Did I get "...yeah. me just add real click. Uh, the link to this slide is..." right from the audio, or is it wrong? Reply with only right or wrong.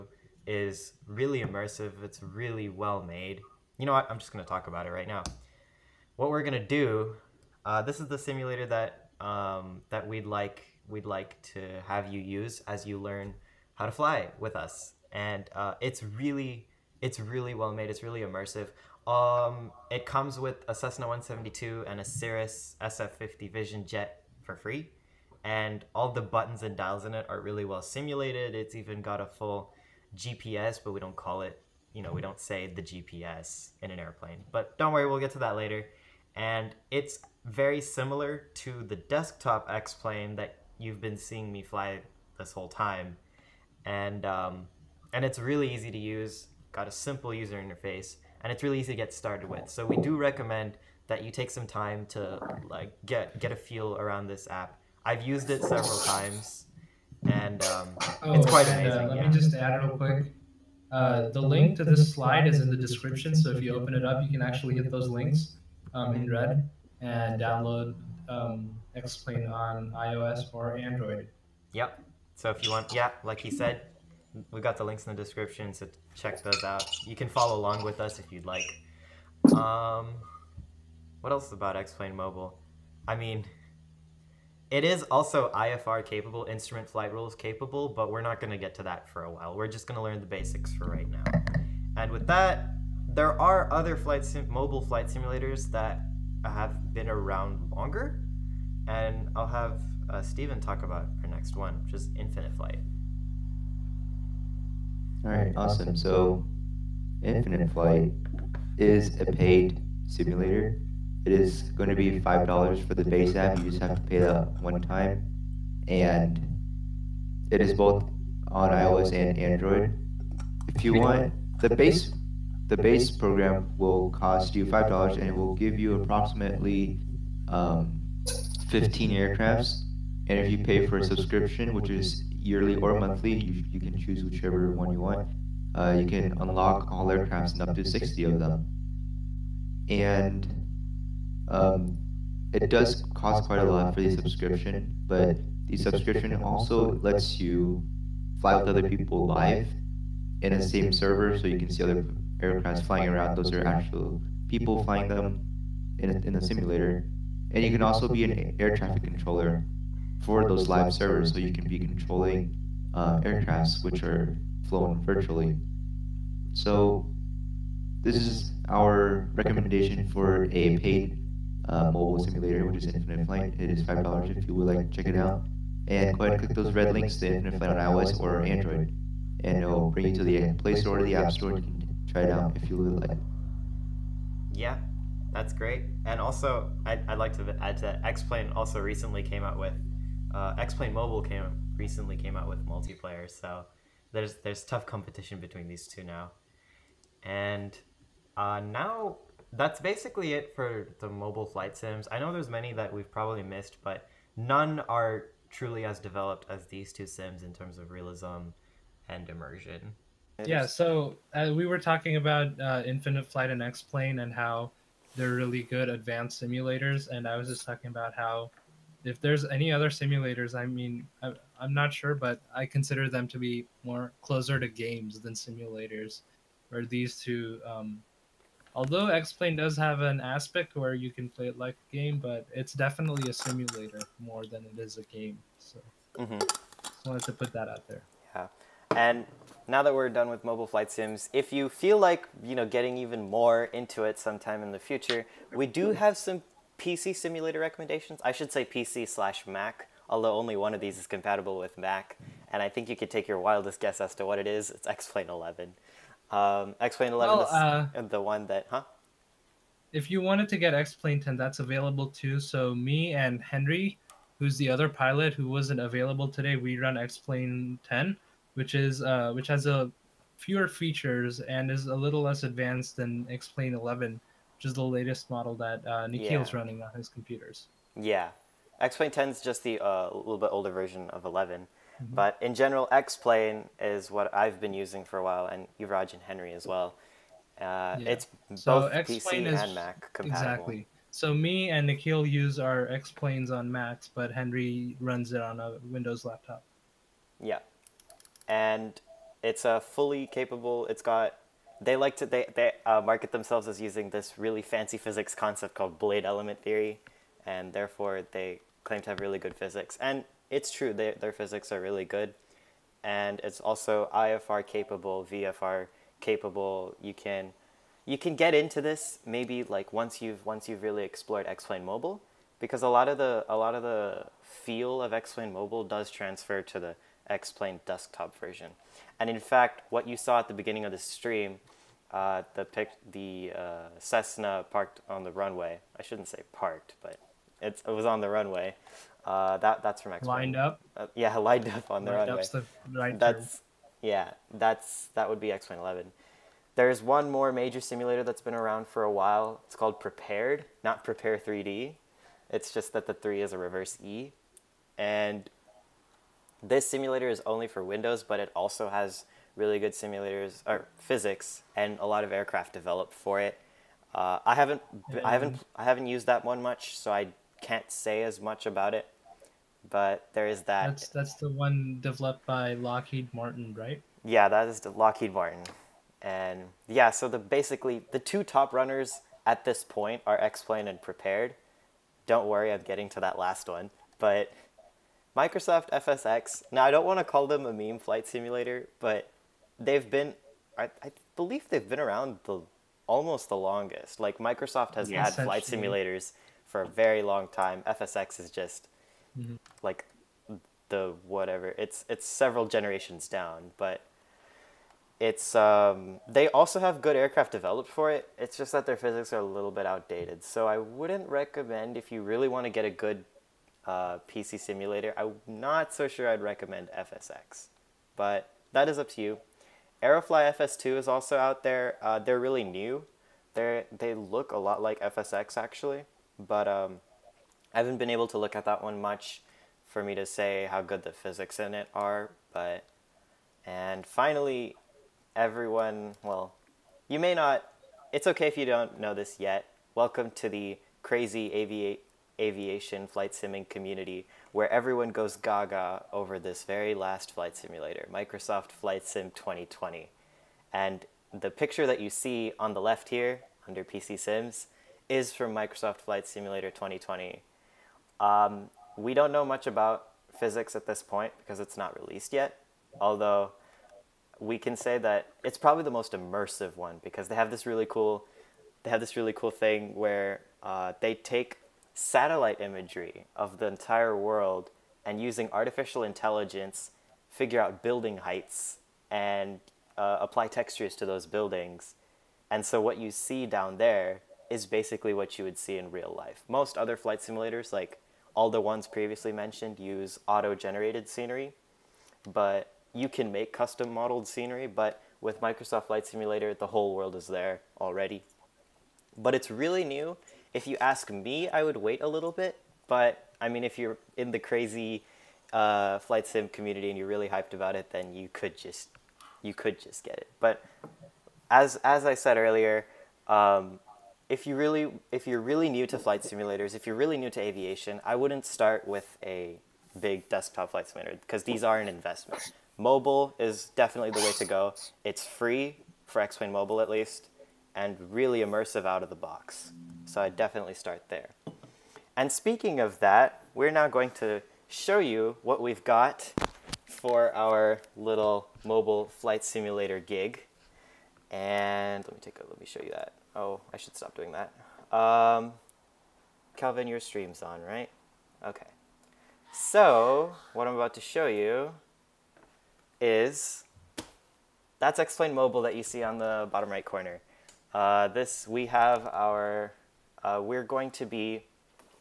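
wrong.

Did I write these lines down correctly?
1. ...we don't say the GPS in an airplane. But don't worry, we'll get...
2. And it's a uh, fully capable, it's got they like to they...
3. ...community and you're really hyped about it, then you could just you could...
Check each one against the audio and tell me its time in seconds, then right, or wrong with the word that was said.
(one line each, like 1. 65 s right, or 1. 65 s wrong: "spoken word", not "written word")
1. 32 s right
2. 298 s right
3. 506 s right.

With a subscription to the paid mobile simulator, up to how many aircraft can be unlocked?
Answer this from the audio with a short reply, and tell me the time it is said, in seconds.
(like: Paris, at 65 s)
60, at 137 s.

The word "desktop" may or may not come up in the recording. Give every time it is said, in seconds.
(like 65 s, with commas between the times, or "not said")
38 s, 327 s, 520 s.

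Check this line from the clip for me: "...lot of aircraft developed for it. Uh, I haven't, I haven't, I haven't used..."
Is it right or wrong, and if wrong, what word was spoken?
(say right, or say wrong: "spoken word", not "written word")
right.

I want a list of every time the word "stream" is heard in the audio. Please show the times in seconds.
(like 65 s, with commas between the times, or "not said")
330 s, 546 s.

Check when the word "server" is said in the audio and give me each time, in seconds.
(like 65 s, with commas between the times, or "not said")
150 s, 160 s.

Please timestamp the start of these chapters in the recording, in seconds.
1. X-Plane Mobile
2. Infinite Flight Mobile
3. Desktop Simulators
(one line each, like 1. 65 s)
1. 6 s
2. 104 s
3. 241 s.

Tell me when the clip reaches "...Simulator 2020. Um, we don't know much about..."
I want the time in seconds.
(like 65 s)
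456 s.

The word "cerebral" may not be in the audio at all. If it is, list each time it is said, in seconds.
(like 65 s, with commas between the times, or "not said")
not said.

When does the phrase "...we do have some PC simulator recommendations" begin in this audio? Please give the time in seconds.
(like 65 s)
245 s.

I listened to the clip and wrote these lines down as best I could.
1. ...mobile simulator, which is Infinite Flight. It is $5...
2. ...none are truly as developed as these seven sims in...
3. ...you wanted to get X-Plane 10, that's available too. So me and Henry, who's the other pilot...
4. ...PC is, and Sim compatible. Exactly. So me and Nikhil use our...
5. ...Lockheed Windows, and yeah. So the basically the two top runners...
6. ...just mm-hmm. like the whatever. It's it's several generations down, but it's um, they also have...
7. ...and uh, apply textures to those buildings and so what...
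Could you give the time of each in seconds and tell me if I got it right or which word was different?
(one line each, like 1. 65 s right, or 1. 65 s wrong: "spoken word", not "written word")
1. 171 s right
2. 204 s wrong: "two", not "seven"
3. 260 s right
4. 289 s wrong: "Mac", not "Sim"
5. 374 s wrong: "Martin", not "Windows"
6. 398 s right
7. 479 s right.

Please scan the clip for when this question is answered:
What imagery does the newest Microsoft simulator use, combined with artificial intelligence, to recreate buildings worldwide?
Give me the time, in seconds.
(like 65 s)
471 s.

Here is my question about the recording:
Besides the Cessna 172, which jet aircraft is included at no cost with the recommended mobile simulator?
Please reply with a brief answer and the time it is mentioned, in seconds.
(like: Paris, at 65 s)
Cirrus SF50 Vision Jet, at 22 s.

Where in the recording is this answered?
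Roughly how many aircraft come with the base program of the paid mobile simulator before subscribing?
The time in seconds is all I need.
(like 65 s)
128 s.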